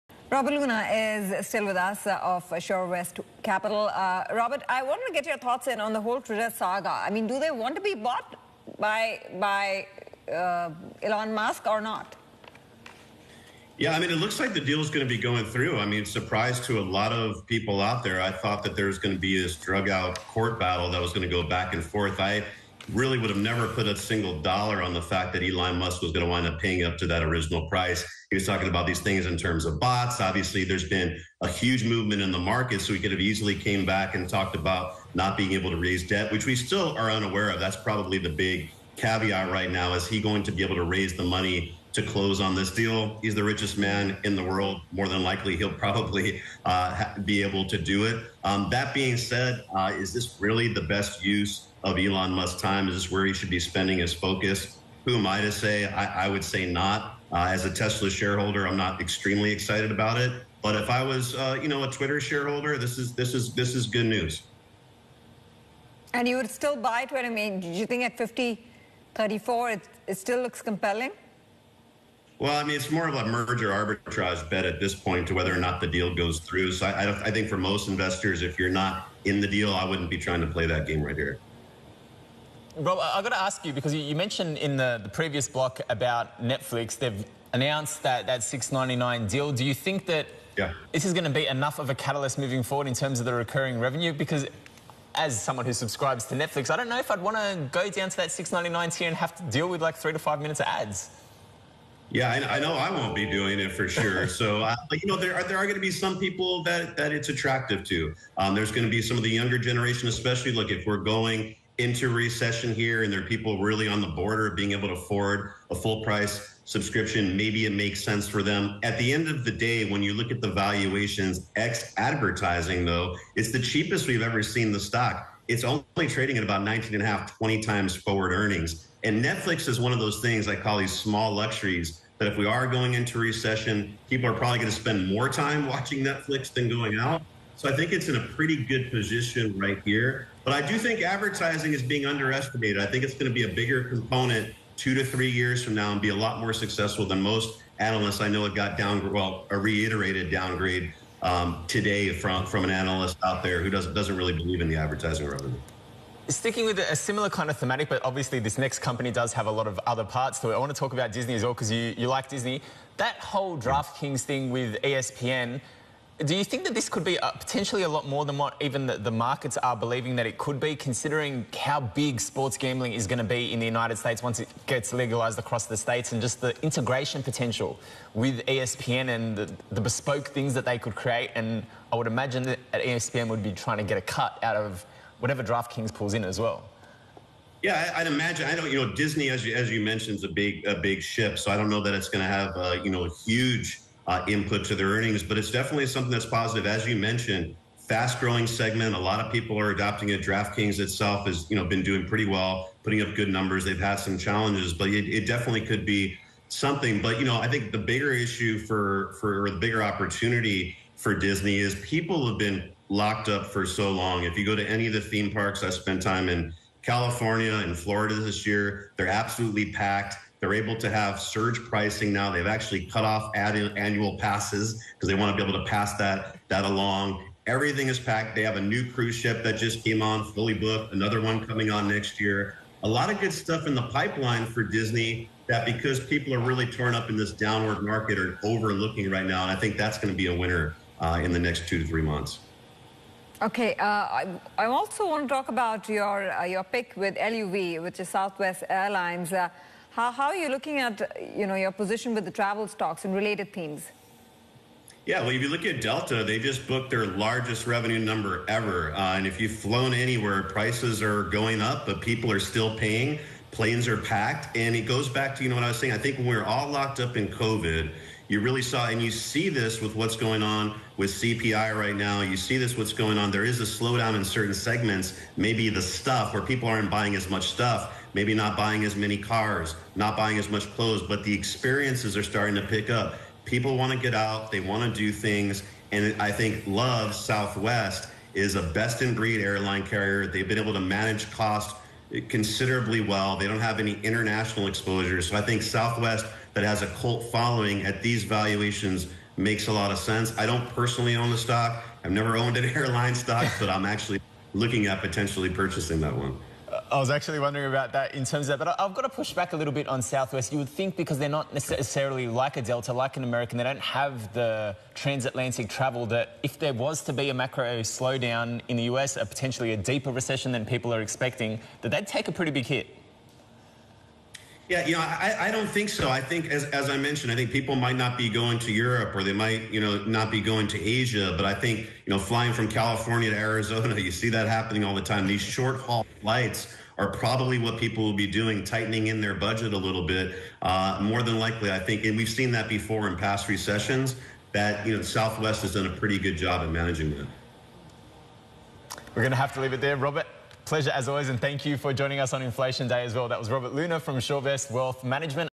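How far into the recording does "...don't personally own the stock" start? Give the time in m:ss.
5:00.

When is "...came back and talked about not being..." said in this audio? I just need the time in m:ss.
0:33.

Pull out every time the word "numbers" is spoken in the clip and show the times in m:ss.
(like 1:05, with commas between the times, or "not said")
3:23, 4:17.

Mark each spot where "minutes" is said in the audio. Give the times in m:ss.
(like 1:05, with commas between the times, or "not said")
1:40.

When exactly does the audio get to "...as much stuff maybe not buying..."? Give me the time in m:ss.
4:37.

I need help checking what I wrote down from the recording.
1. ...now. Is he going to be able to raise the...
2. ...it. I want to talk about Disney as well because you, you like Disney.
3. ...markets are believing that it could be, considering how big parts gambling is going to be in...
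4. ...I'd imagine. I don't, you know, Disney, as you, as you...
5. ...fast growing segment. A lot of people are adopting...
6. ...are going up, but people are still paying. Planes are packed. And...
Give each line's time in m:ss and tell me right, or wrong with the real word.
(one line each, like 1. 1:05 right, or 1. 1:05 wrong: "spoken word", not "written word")
1. 0:39 right
2. 2:40 right
3. 2:49 wrong: "sports", not "parts"
4. 3:07 right
5. 3:17 right
6. 4:21 right.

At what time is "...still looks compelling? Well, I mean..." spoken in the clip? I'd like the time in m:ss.
1:10.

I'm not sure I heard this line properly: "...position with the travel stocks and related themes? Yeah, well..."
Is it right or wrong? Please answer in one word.
right.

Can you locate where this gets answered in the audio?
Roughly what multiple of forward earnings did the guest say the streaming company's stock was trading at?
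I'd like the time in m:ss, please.
2:06.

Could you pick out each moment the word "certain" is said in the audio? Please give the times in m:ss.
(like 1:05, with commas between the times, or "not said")
4:34.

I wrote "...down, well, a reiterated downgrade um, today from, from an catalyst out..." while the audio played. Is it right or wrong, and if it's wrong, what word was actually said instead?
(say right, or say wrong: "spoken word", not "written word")
wrong: "analyst", not "catalyst".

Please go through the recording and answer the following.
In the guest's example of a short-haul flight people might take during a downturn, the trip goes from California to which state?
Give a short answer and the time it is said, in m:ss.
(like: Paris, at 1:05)
Arizona, at 5:33.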